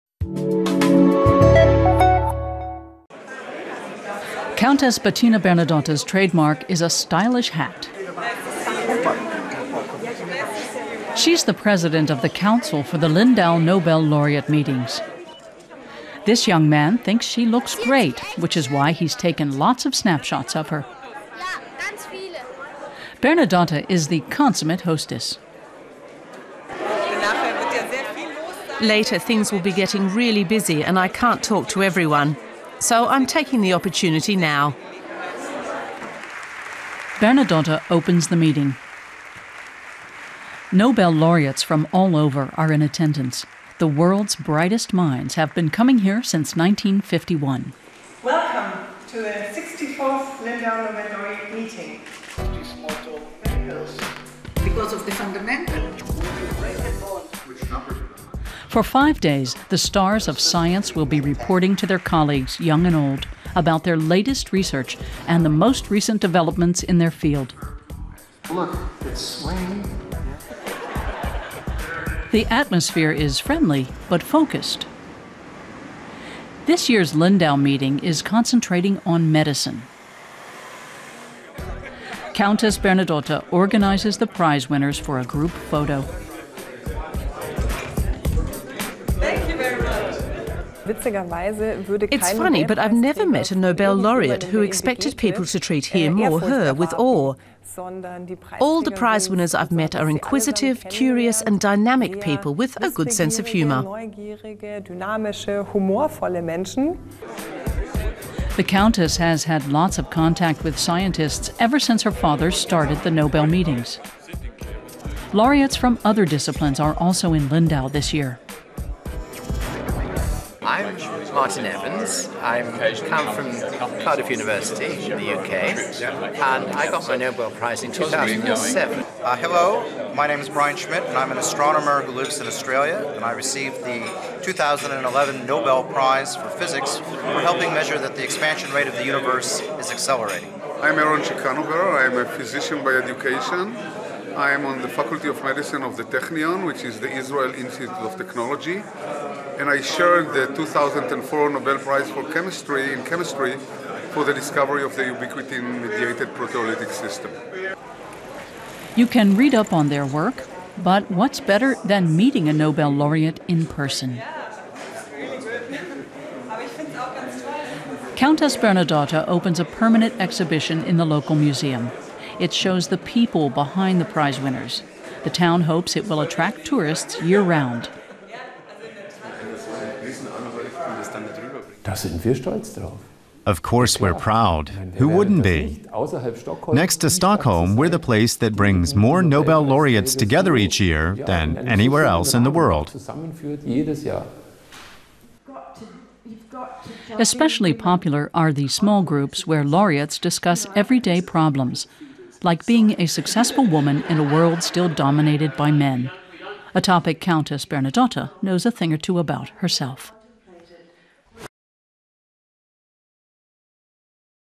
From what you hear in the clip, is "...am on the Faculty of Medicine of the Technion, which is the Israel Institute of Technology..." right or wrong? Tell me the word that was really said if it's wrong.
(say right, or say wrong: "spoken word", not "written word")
right.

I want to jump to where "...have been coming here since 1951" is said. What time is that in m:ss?
0:45.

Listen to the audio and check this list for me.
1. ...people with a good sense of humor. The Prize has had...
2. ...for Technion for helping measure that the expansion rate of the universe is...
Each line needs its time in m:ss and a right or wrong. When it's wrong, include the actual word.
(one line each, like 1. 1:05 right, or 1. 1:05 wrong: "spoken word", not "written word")
1. 1:42 wrong: "Countess", not "Prize"
2. 2:16 wrong: "Physics", not "Technion".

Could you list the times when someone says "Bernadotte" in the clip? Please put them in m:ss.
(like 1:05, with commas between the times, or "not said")
0:05, 0:23, 0:37, 1:22, 2:48, 3:27.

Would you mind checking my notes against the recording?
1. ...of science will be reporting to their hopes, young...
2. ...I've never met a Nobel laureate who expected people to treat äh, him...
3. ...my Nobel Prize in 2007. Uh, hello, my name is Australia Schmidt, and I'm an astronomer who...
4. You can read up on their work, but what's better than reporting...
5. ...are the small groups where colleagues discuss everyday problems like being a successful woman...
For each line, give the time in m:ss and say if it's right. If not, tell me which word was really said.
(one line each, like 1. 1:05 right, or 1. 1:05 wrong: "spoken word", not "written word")
1. 1:00 wrong: "colleagues", not "hopes"
2. 1:32 right
3. 2:07 wrong: "Brian", not "Australia"
4. 2:38 wrong: "meeting", not "reporting"
5. 3:18 wrong: "laureates", not "colleagues".